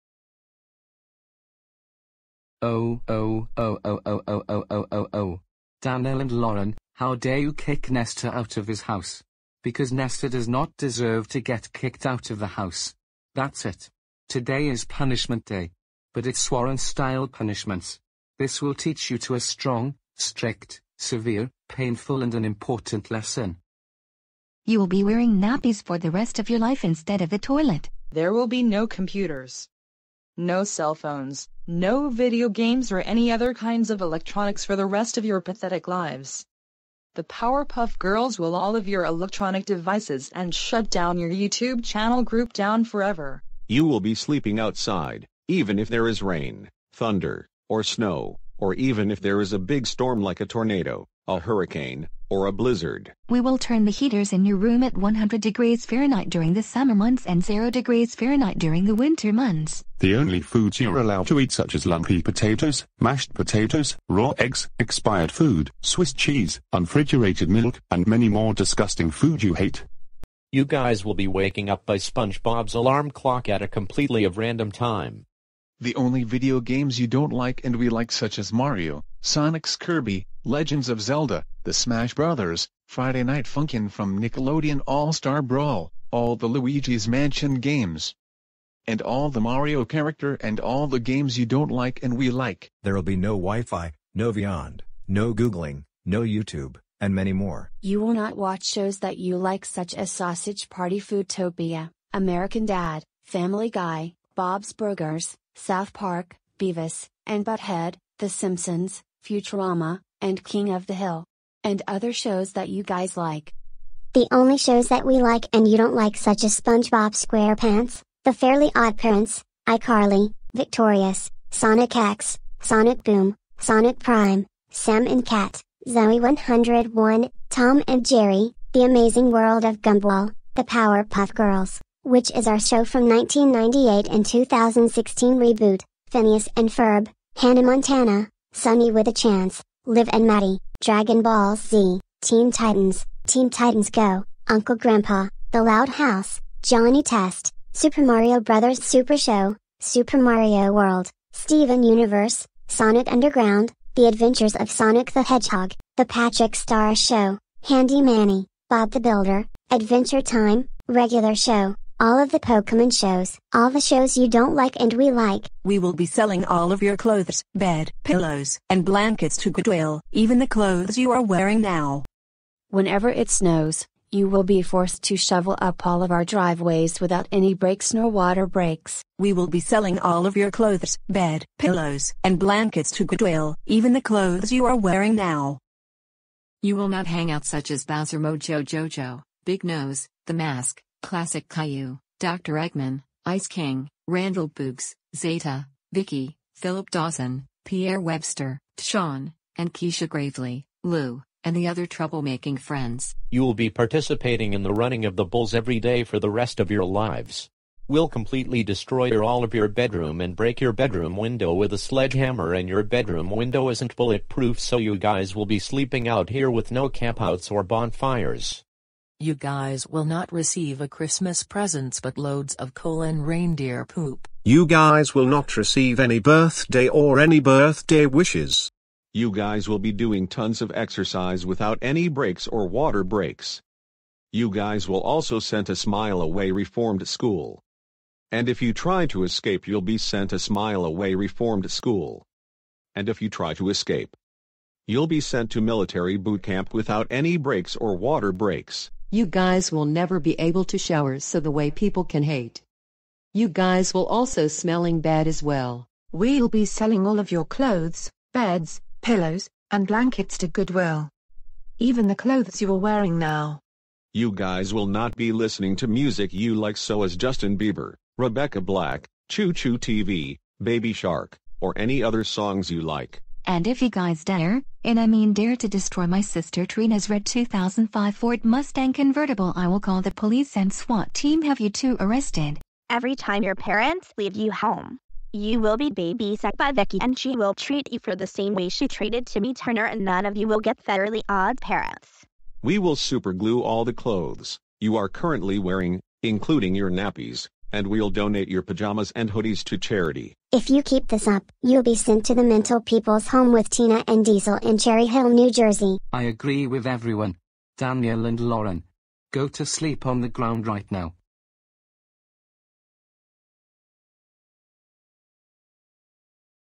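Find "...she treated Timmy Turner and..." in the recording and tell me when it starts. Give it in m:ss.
4:48.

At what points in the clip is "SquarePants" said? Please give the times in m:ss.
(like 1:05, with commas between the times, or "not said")
1:57.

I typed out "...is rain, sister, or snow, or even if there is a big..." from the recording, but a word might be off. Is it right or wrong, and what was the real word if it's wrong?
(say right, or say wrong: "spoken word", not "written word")
wrong: "thunder", not "sister".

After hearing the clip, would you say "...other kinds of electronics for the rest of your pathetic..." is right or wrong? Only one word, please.
right.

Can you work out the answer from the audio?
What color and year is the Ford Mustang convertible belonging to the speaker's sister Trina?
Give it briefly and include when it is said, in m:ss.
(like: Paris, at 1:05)
Red 2005, at 4:37.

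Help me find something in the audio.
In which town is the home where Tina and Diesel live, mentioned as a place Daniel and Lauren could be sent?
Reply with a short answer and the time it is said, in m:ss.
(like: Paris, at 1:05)
Cherry Hill, New Jersey, at 5:04.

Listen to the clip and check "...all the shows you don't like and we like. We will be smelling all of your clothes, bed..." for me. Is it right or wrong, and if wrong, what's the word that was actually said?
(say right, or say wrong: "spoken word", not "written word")
wrong: "selling", not "smelling".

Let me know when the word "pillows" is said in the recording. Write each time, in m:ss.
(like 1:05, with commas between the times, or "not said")
2:48, 3:01, 4:19.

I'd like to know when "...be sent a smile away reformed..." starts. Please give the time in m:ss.
3:59.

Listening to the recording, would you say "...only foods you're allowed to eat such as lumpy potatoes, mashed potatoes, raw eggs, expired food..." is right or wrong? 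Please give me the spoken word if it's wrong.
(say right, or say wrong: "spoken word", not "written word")
right.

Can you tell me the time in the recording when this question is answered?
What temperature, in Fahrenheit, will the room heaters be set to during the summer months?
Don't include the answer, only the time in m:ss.
0:54.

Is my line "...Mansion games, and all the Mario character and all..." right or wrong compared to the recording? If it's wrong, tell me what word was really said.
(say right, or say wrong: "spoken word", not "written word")
right.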